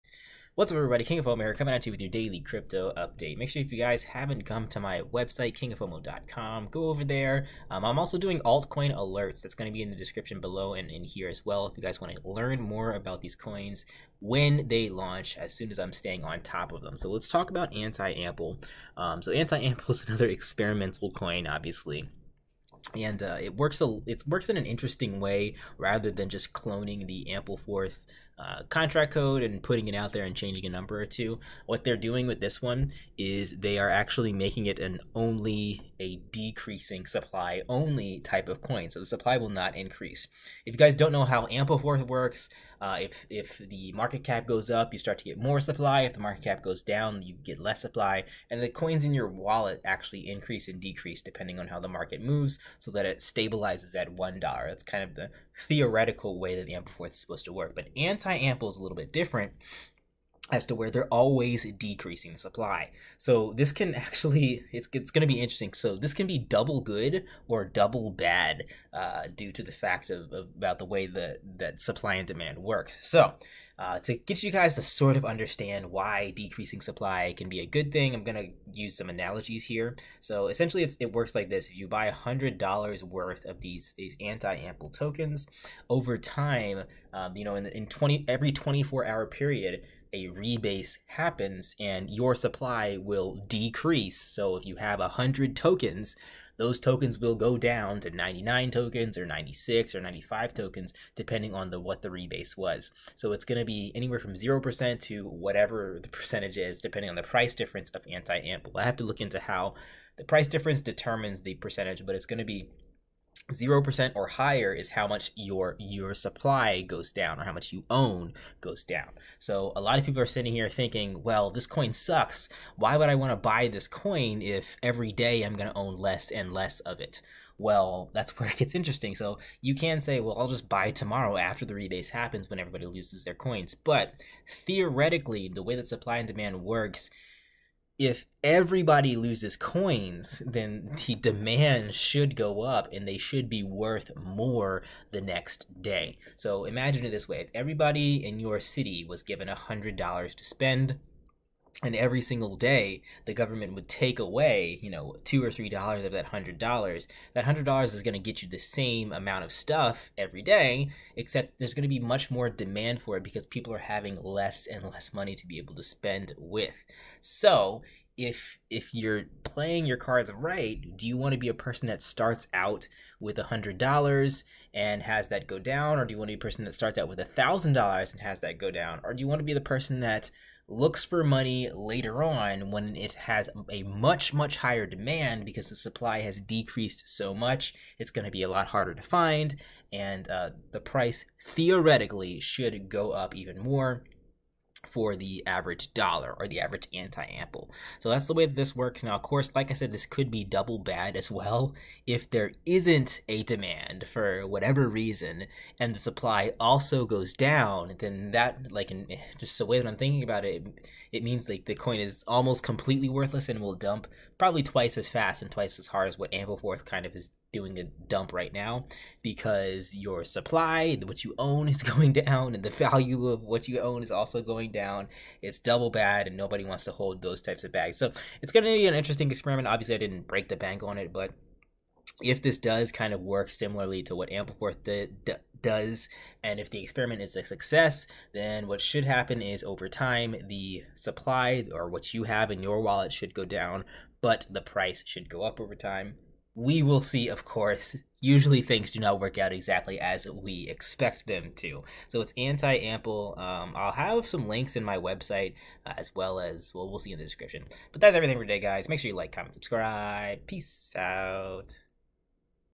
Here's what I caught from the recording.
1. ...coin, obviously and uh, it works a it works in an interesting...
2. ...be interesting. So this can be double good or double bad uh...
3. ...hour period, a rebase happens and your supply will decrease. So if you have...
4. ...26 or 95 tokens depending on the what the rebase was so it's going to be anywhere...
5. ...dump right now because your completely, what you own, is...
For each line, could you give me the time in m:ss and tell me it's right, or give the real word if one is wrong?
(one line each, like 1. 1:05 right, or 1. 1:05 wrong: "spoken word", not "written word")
1. 0:21 right
2. 1:05 right
3. 1:29 right
4. 1:39 wrong: "96", not "26"
5. 3:38 wrong: "supply", not "completely".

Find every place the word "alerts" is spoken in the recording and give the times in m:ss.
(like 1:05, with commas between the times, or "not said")
0:08.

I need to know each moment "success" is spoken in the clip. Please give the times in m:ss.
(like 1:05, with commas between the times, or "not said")
3:57.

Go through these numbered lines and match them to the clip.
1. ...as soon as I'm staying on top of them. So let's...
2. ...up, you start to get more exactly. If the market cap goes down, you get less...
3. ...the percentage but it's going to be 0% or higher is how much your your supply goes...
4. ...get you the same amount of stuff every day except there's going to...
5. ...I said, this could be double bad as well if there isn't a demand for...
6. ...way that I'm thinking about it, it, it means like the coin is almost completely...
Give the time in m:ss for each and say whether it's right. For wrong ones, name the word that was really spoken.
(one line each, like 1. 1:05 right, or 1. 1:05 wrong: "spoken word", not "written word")
1. 0:15 right
2. 0:44 wrong: "supply", not "exactly"
3. 1:51 right
4. 2:38 right
5. 3:19 right
6. 3:29 right.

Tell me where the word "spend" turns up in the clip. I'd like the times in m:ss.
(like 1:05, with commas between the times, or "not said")
2:30, 2:45.